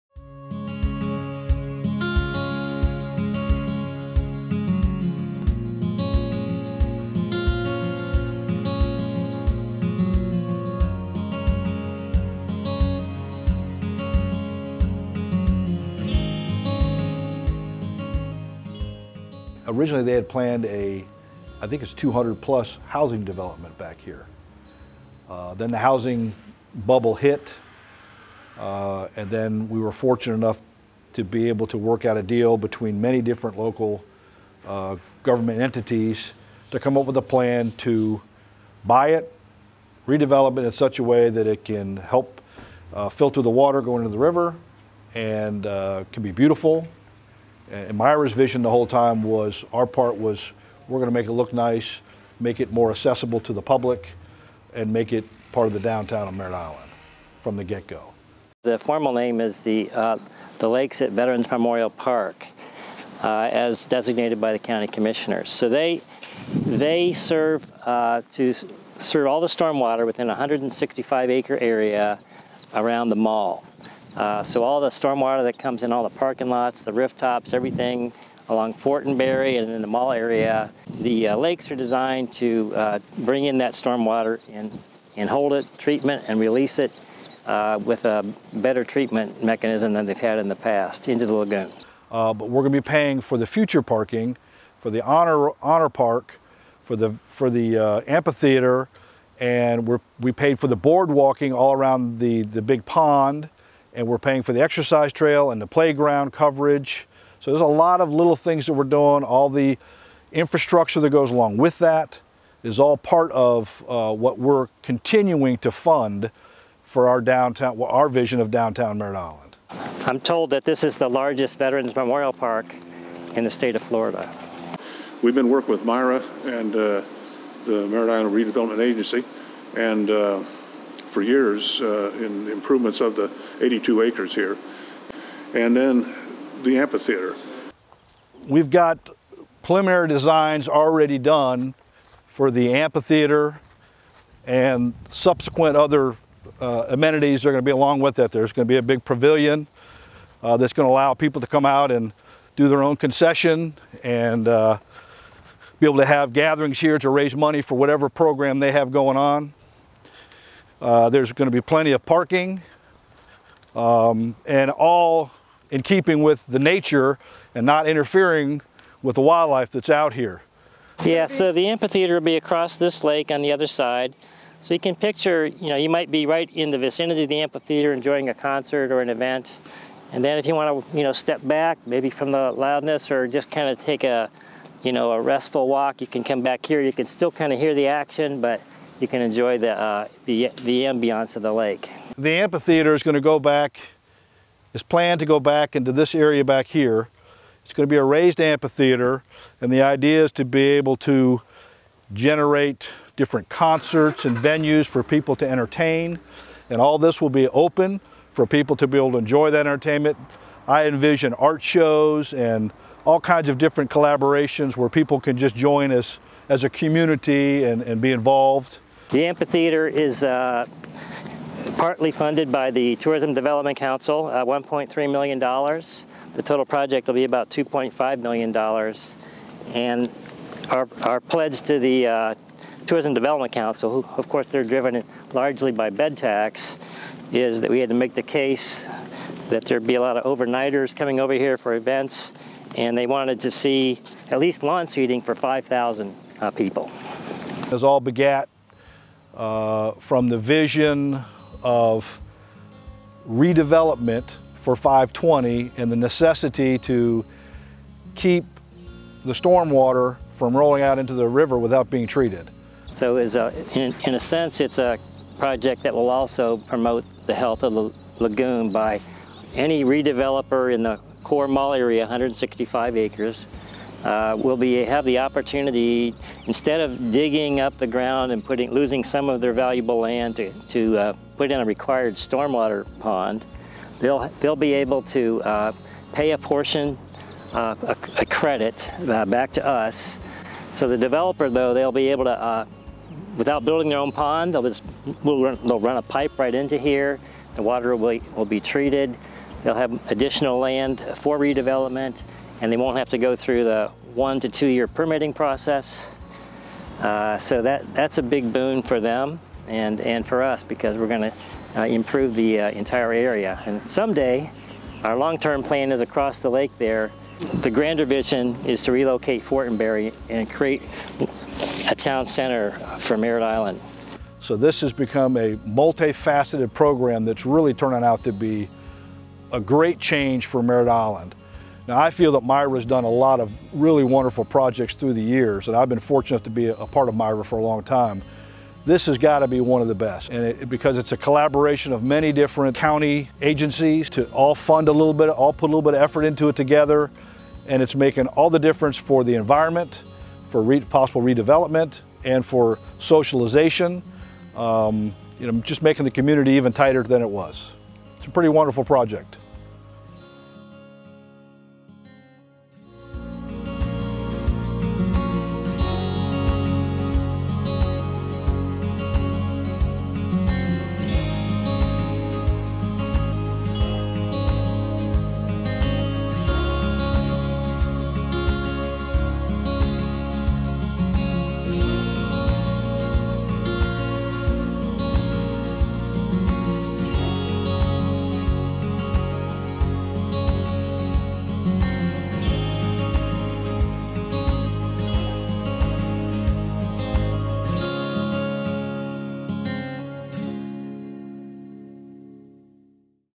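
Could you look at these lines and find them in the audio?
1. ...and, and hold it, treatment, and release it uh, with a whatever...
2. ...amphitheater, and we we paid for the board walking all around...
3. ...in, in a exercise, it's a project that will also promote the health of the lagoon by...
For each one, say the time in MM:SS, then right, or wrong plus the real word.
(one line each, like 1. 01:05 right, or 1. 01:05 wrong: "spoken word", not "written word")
1. 01:24 wrong: "better", not "whatever"
2. 01:38 right
3. 04:23 wrong: "sense", not "exercise".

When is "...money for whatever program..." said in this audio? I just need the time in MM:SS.
02:37.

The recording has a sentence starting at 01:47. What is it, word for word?
So there's a lot of little things that we're doing.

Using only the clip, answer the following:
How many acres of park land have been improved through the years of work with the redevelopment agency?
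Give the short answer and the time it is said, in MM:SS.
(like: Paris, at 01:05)
82 acres, at 02:13.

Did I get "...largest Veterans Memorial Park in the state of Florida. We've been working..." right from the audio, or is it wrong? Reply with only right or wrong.
right.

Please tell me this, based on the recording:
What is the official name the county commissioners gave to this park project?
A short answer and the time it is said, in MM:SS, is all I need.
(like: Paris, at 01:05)
The Lakes at Veterans Memorial Park, at 01:00.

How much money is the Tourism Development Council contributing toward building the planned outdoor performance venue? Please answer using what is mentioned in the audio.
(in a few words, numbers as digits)
$1.3 million.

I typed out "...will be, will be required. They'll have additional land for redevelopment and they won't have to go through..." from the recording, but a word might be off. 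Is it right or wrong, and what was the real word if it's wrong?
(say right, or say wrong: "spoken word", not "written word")
wrong: "treated", not "required".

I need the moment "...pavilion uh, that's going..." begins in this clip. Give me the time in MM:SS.
02:29.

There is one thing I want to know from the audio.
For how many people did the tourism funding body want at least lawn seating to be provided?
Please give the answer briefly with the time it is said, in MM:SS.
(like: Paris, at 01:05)
5,000, at 04:05.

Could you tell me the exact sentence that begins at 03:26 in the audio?
And all this will be open for people to be able to enjoy that entertainment.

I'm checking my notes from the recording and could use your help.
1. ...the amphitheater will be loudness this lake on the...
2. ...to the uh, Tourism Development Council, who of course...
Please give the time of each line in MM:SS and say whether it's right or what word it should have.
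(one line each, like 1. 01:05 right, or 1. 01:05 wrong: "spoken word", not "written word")
1. 02:51 wrong: "across", not "loudness"
2. 03:51 right.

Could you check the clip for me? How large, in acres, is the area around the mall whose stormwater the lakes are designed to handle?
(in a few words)
165 acres.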